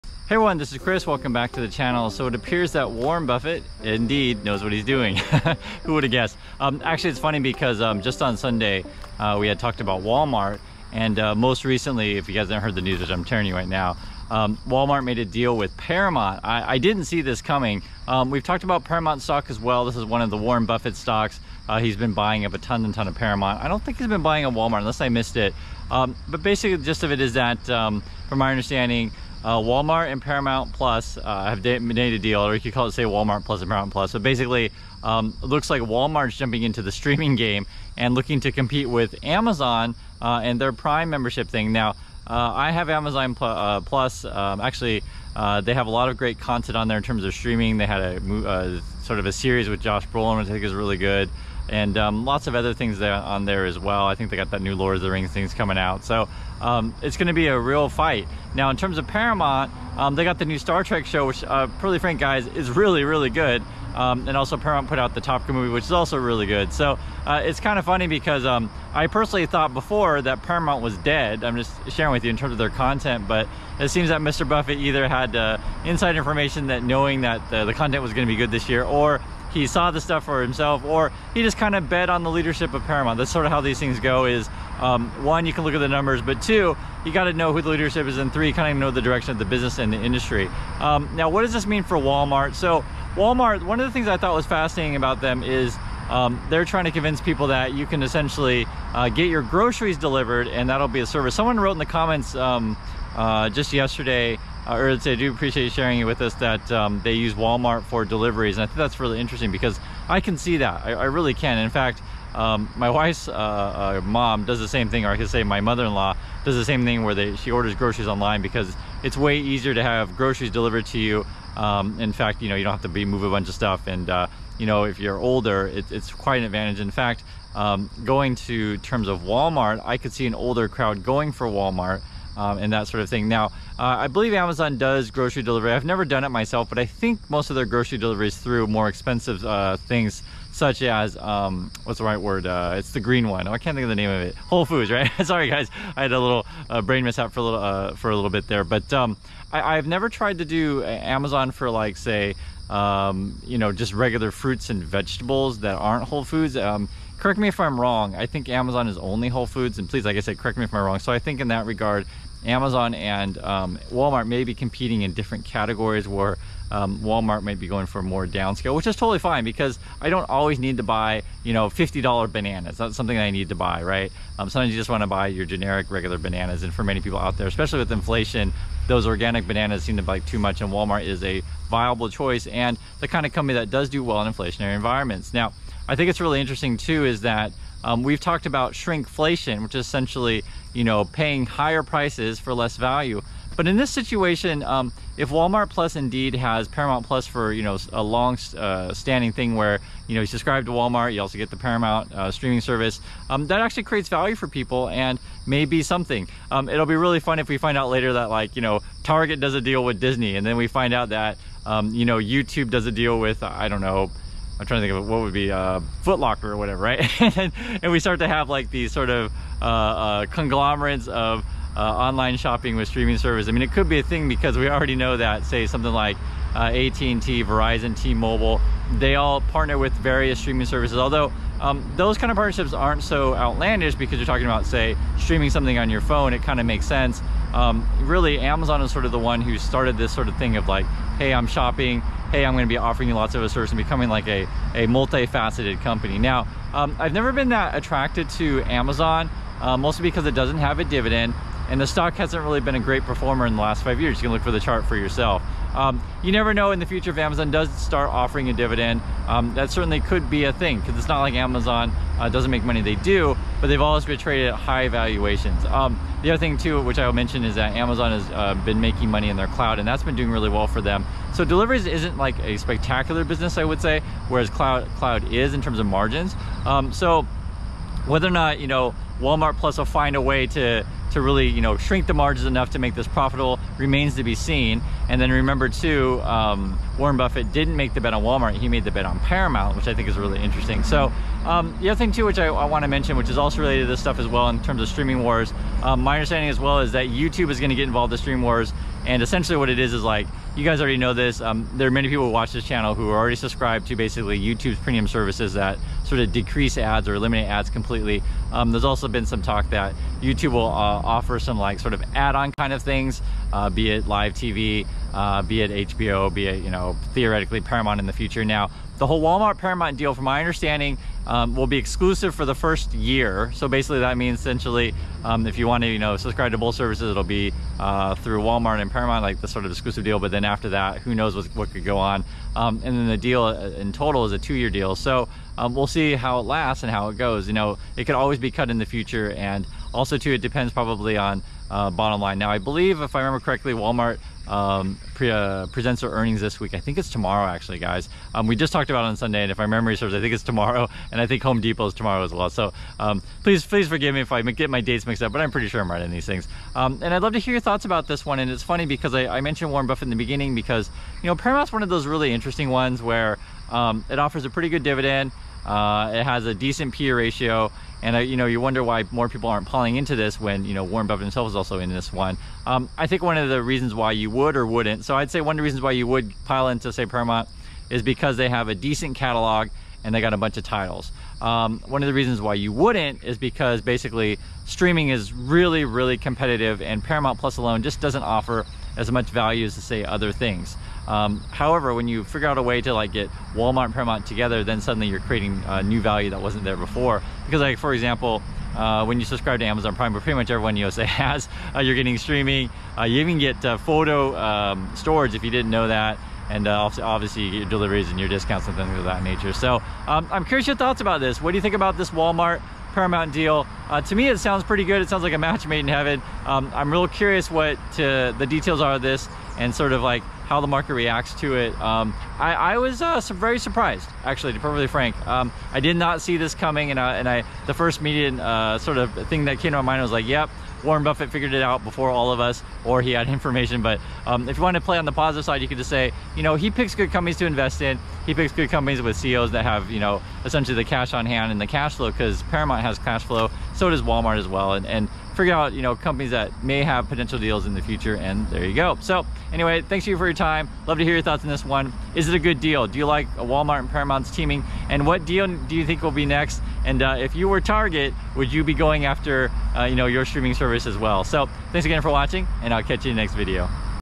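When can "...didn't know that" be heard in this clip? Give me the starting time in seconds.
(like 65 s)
405 s.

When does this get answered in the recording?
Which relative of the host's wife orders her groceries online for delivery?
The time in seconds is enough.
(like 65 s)
115 s.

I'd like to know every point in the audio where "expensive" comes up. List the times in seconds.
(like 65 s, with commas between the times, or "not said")
138 s.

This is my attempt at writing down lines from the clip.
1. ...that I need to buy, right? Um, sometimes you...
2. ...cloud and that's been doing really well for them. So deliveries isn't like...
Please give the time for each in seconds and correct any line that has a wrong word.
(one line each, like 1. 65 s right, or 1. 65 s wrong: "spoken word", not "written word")
1. 173 s right
2. 269 s right.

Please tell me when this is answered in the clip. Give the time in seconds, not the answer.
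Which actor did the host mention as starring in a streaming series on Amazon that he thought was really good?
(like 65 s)
49 s.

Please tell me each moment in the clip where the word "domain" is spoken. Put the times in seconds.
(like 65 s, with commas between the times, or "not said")
not said.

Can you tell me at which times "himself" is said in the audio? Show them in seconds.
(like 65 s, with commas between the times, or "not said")
80 s, 371 s.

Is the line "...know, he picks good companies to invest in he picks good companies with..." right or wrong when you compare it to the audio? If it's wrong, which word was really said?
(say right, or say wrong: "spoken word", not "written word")
right.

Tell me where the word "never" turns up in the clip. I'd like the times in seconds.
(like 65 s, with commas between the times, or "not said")
135 s, 149 s, 247 s, 256 s.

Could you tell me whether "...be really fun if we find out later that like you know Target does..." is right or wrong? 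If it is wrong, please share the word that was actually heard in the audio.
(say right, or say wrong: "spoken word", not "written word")
right.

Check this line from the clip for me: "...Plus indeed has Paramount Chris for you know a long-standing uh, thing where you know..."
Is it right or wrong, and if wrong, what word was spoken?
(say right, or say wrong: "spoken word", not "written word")
wrong: "Plus", not "Chris".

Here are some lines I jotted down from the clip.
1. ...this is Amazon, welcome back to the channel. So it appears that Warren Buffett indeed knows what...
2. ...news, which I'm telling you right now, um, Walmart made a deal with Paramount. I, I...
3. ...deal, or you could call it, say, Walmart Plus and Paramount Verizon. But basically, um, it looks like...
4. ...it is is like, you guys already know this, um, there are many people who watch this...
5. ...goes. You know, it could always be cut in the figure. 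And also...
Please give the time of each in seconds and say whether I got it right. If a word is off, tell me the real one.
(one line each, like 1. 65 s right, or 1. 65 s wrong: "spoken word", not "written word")
1. 0 s wrong: "Chris", not "Amazon"
2. 12 s right
3. 32 s wrong: "Plus", not "Verizon"
4. 299 s right
5. 337 s wrong: "future", not "figure".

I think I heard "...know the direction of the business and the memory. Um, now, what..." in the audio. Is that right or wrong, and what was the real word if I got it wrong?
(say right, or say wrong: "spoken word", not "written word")
wrong: "industry", not "memory".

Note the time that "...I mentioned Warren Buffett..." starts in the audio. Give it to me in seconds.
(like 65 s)
359 s.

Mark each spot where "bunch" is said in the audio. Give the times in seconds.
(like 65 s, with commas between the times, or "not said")
123 s, 380 s.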